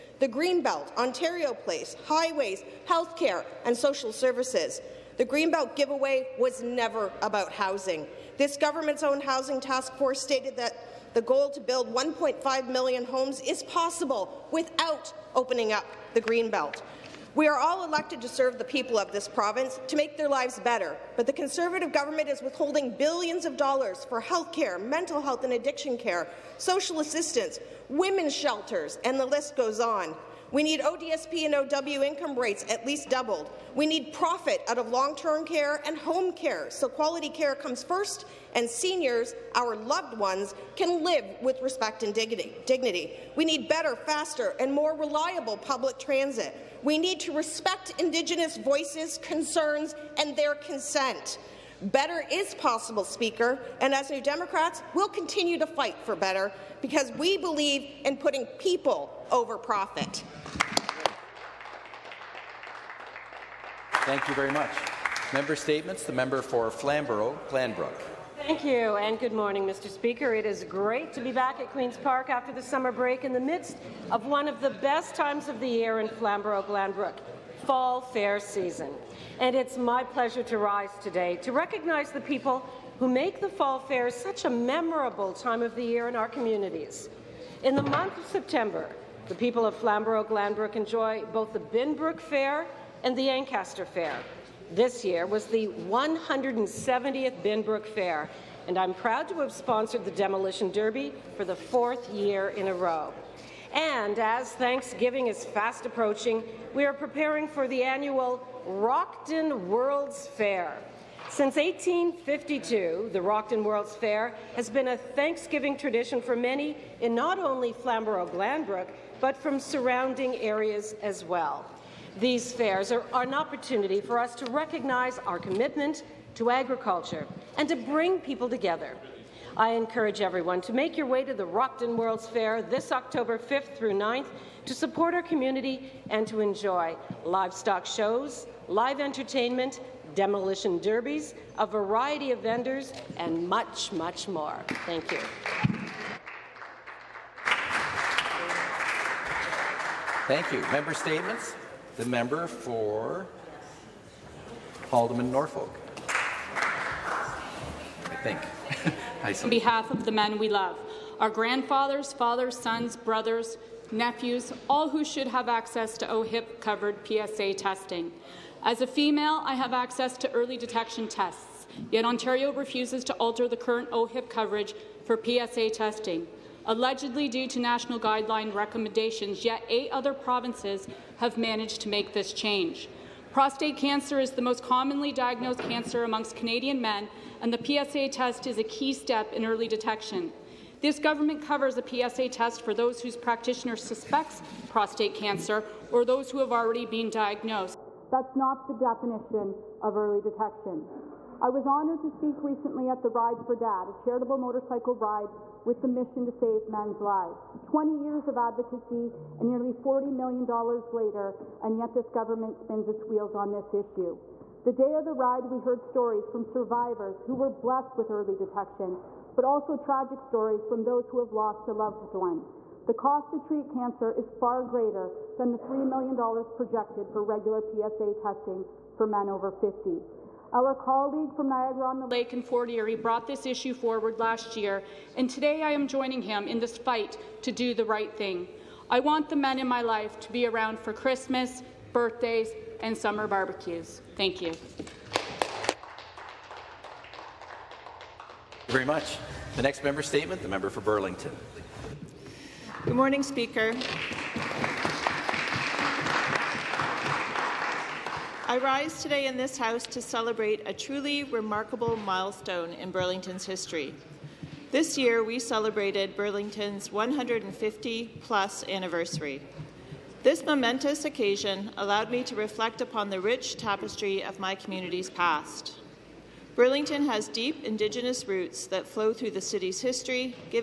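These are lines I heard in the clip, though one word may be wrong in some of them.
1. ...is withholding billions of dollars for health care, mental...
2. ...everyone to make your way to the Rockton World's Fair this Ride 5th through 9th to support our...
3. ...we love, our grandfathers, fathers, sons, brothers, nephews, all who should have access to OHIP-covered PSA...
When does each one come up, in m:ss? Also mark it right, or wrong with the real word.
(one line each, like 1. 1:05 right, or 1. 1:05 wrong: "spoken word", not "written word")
1. 0:22 right
2. 2:10 wrong: "October", not "Ride"
3. 2:40 right.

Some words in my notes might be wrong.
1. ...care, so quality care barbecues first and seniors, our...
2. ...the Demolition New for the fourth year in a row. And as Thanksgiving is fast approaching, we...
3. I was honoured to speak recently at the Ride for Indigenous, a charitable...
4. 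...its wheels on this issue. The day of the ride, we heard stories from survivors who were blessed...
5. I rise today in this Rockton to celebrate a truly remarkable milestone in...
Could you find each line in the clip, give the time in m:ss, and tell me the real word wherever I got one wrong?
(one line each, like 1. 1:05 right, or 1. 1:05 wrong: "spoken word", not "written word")
1. 0:36 wrong: "comes", not "barbecues"
2. 1:40 wrong: "Derby", not "New"
3. 3:21 wrong: "Dad", not "Indigenous"
4. 3:32 right
5. 4:18 wrong: "House", not "Rockton".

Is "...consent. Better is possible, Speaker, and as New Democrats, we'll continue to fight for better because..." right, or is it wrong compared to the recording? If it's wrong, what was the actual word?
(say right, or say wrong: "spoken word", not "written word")
right.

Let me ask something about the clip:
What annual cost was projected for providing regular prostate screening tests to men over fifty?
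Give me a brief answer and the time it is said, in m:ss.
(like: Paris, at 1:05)
$3 million, at 3:45.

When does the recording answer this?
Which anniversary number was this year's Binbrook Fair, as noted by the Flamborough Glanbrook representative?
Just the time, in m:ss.
1:35.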